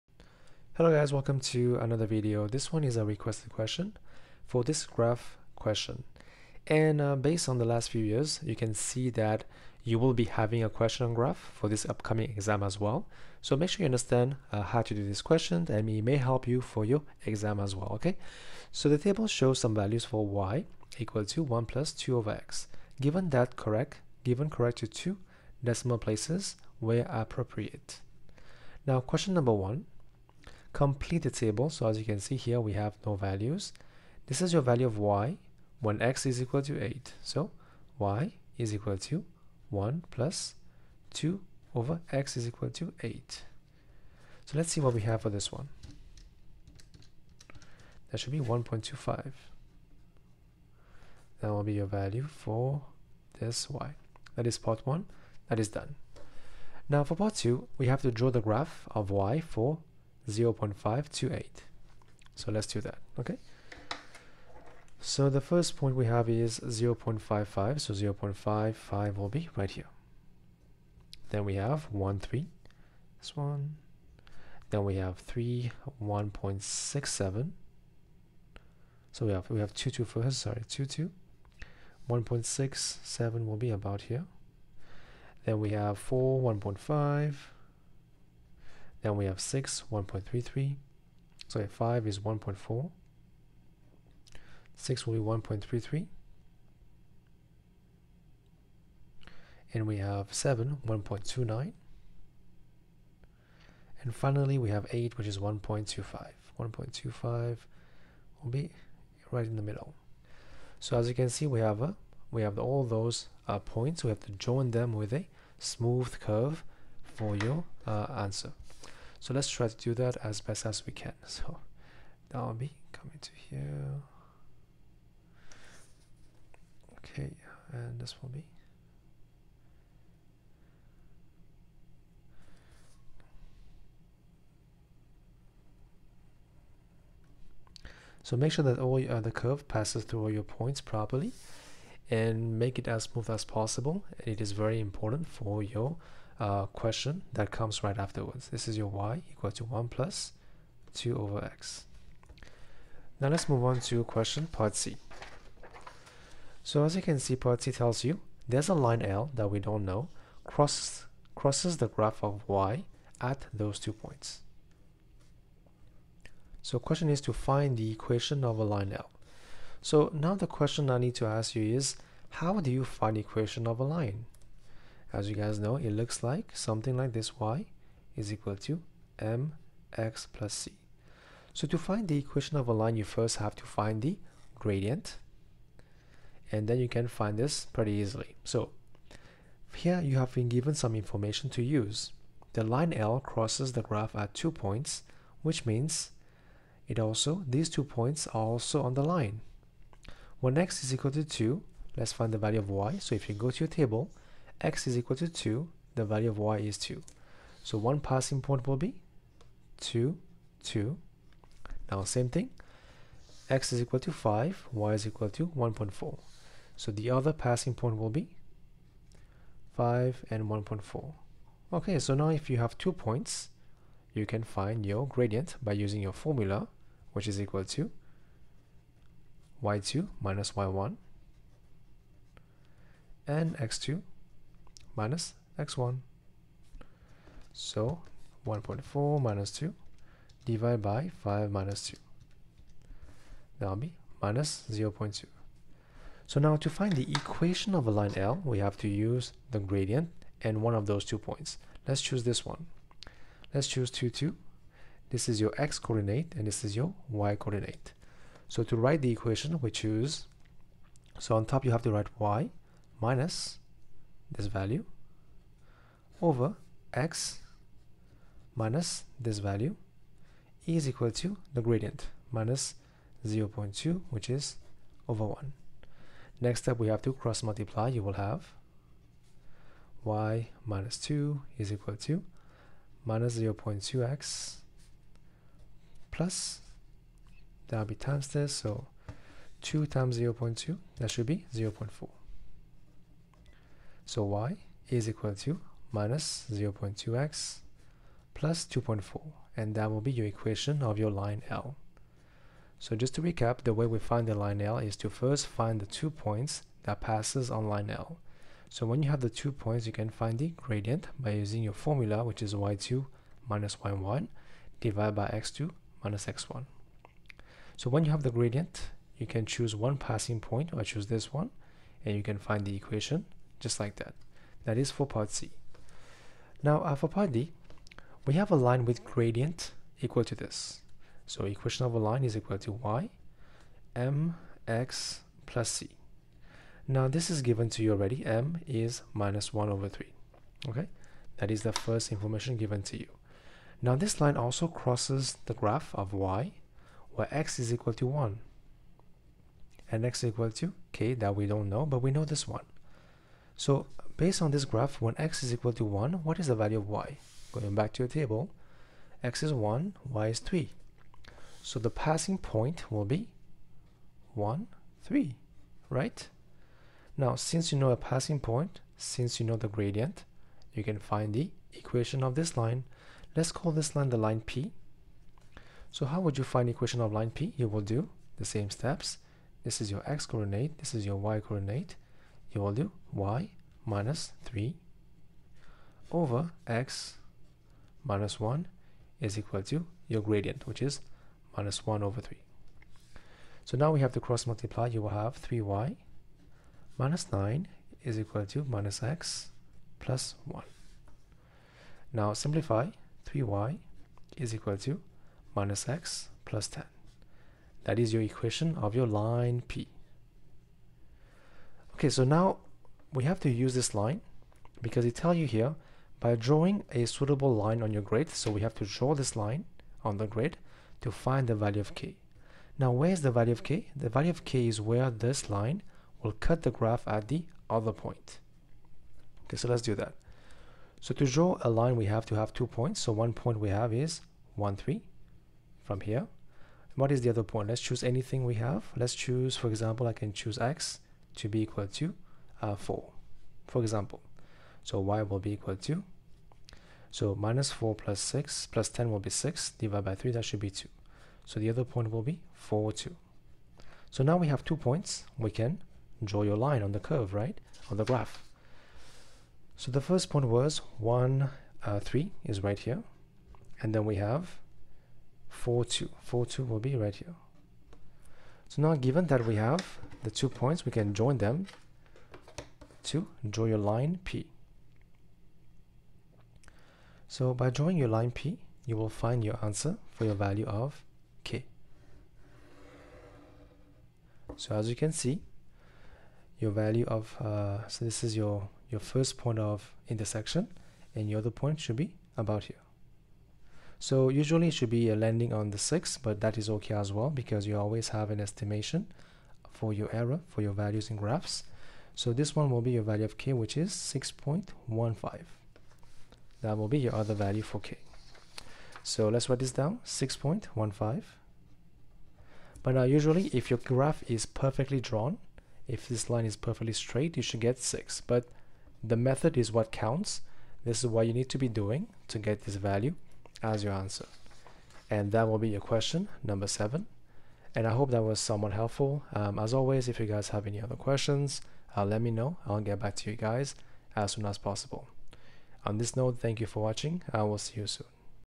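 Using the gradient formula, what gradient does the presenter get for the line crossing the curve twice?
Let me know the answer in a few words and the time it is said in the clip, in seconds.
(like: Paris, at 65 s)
-0.2, at 244 s.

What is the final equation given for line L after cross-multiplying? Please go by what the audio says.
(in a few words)
y = -0.2x + 2.4.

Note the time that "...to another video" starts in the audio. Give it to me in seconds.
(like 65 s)
1 s.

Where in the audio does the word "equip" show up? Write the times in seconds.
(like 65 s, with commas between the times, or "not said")
not said.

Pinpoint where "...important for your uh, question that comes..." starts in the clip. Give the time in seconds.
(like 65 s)
144 s.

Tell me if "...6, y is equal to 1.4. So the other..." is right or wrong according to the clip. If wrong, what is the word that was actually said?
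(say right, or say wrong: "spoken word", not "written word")
wrong: "5", not "6".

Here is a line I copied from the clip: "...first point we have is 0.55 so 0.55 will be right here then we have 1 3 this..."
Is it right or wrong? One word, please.
right.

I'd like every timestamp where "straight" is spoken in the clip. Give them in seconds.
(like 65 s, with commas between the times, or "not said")
516 s.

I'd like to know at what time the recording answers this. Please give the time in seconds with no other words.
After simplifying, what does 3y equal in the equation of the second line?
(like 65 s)
405 s.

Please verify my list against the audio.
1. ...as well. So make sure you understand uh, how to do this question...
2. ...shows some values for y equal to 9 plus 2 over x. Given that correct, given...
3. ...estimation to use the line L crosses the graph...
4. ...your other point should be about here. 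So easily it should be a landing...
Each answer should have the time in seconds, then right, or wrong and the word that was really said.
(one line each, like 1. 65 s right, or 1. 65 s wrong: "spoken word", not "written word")
1. 12 s right
2. 19 s wrong: "1", not "9"
3. 190 s wrong: "information", not "estimation"
4. 491 s wrong: "usually", not "easily".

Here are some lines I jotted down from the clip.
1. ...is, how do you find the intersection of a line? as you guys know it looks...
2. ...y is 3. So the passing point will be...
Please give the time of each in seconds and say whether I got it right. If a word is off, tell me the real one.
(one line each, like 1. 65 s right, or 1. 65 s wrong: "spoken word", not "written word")
1. 171 s wrong: "equation", not "intersection"
2. 360 s right.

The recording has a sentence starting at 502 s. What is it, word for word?
So this one will be your value of k, which is 6.15.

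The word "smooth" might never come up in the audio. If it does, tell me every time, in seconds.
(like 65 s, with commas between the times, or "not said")
115 s, 143 s.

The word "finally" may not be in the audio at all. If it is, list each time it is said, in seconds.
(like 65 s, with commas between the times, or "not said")
104 s.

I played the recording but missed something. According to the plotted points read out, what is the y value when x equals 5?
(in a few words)
1.4.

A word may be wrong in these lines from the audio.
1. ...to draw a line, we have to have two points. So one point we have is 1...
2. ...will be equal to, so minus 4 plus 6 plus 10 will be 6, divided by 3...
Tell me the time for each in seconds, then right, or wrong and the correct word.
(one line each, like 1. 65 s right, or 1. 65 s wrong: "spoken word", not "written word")
1. 431 s right
2. 445 s right.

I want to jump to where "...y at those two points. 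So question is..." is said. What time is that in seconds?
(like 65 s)
162 s.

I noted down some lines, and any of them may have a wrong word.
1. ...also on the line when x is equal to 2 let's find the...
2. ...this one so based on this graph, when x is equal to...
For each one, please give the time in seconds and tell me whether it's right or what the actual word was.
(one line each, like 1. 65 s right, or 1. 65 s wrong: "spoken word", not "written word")
1. 198 s right
2. 352 s right.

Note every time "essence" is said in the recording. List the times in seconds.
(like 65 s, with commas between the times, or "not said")
not said.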